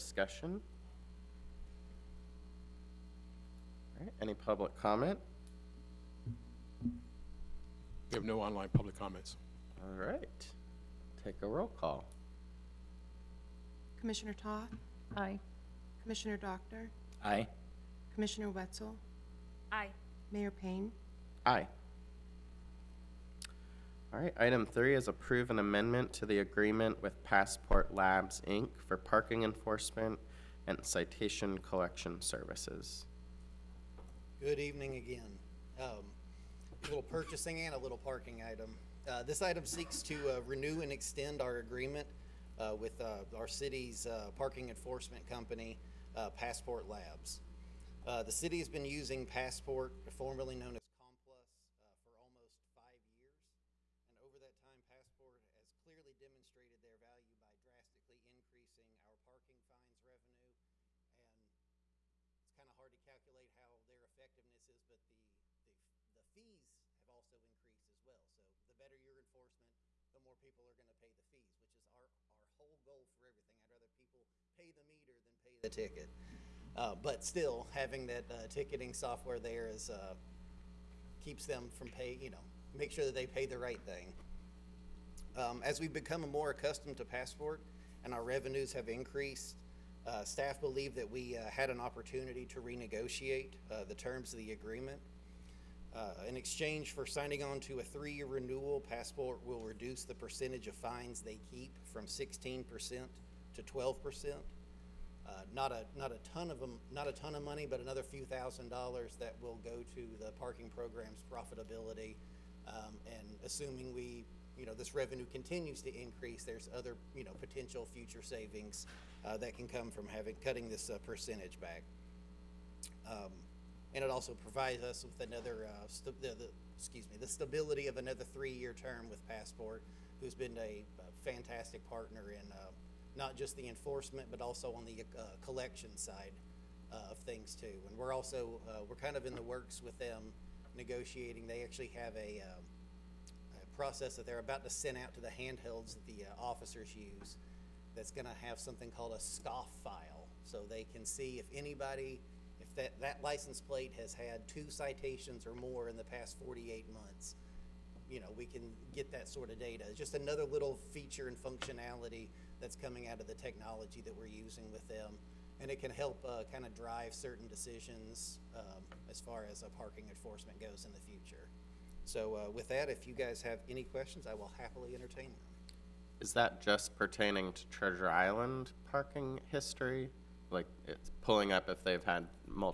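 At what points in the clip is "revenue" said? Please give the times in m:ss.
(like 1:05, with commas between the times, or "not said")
1:00, 1:28, 1:54.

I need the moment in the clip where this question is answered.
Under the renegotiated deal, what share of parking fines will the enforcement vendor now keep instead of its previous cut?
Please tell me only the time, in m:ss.
1:43.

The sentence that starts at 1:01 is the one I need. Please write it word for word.
And it's kind of hard to calculate how their effectiveness is, but the, the, the fees have also increased as well.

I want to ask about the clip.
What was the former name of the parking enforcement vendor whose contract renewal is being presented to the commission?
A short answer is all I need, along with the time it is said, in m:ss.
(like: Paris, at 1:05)
Complus, at 0:50.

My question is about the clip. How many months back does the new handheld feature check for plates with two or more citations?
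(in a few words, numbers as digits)
48 months.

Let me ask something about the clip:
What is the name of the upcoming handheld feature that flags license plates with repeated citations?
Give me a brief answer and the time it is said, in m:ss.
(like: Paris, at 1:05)
scoff file, at 2:29.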